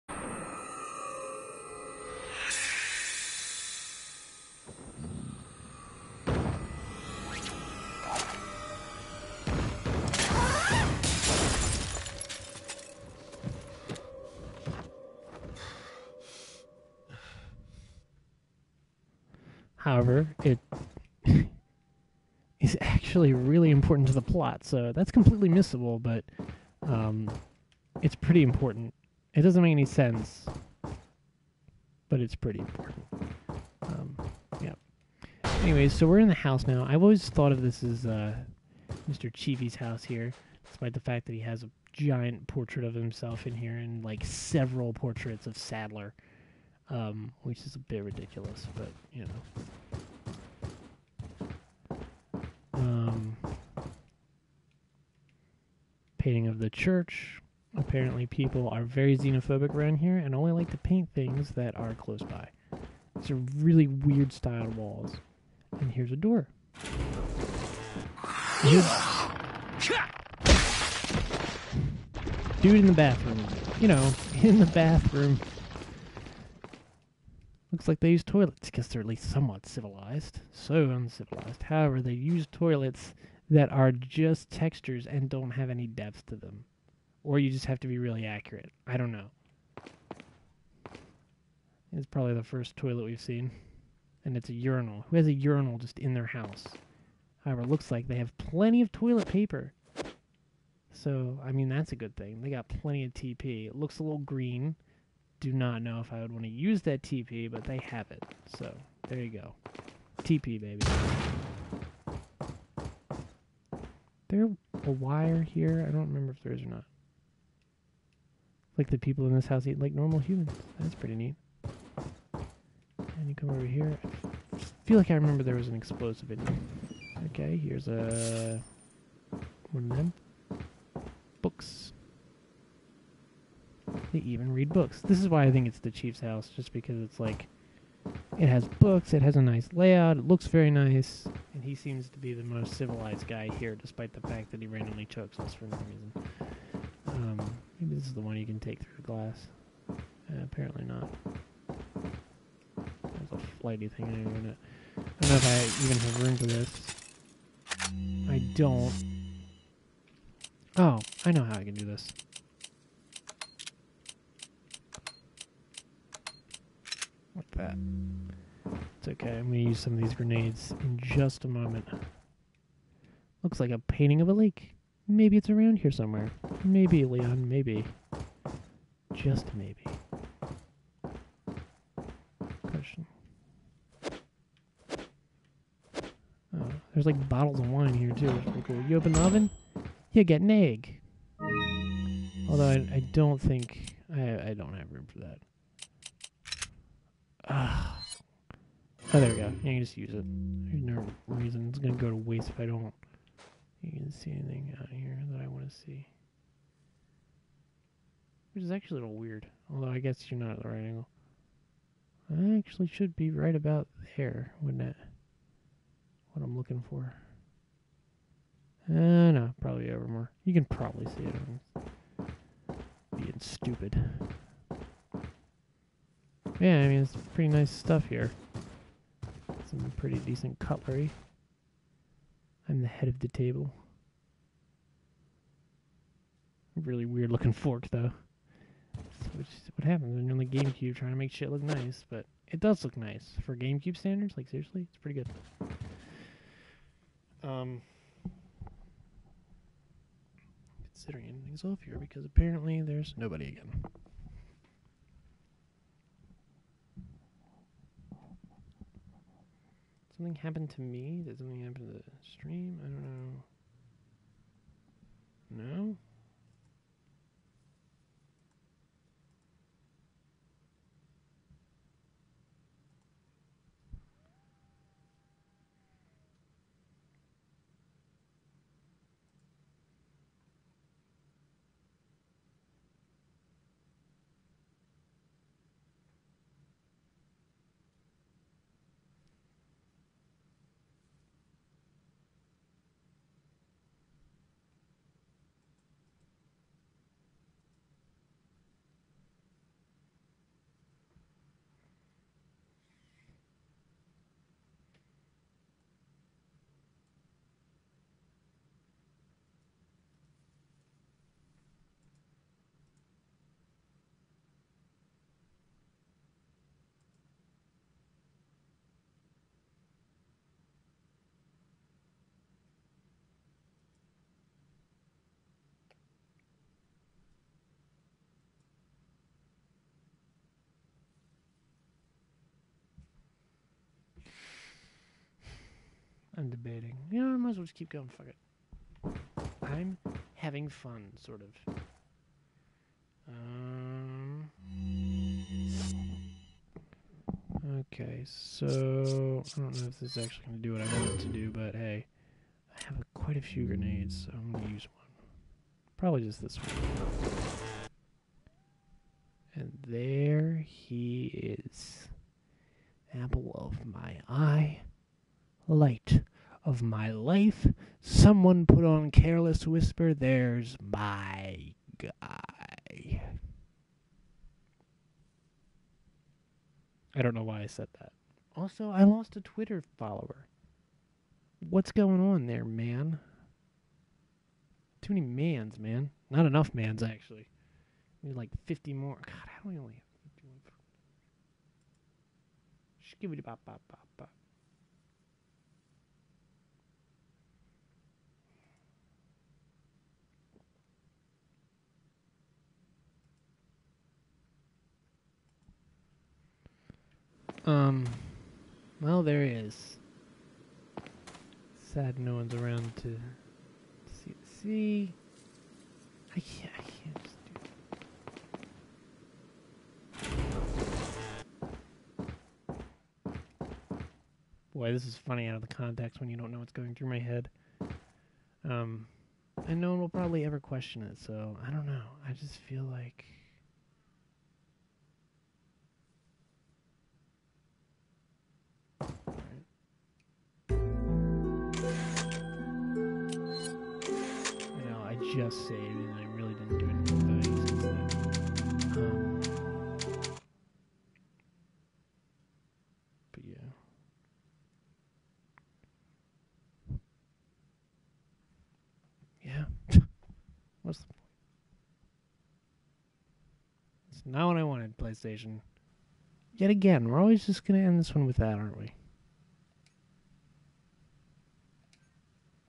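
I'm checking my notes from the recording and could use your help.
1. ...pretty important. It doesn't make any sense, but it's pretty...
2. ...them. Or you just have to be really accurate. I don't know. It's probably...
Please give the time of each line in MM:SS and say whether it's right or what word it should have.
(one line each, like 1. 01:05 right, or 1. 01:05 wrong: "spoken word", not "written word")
1. 00:28 right
2. 01:26 right.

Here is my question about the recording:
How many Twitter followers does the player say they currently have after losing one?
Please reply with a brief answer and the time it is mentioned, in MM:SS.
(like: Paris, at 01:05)
51, at 06:30.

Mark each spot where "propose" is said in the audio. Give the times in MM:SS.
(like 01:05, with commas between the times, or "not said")
not said.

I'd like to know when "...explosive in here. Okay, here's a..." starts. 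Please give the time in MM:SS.
02:05.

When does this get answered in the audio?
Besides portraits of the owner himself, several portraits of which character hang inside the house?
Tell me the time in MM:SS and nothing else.
00:45.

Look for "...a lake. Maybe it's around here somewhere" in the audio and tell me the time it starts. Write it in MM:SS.
02:54.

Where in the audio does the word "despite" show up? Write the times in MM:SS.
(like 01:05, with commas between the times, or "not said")
00:40, 02:23.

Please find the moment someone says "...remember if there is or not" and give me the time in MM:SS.
01:56.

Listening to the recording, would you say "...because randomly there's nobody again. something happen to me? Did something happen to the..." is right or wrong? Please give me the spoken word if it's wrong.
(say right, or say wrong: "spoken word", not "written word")
wrong: "apparently", not "randomly".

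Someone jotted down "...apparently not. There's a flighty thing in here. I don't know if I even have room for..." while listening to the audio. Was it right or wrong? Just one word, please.
right.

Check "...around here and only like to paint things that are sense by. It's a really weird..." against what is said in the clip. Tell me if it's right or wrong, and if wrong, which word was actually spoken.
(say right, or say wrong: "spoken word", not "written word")
wrong: "close", not "sense".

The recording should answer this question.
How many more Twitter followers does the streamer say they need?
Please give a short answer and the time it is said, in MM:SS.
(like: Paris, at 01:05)
50, at 06:28.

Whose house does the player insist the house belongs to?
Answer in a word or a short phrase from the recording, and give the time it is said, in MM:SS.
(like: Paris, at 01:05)
Mr. Chivi, at 00:39.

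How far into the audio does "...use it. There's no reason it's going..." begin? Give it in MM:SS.
03:19.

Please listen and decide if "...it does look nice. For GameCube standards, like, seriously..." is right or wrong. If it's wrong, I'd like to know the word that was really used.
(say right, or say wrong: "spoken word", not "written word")
right.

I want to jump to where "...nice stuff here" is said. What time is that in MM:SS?
03:47.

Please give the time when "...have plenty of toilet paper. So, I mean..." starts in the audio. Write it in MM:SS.
01:38.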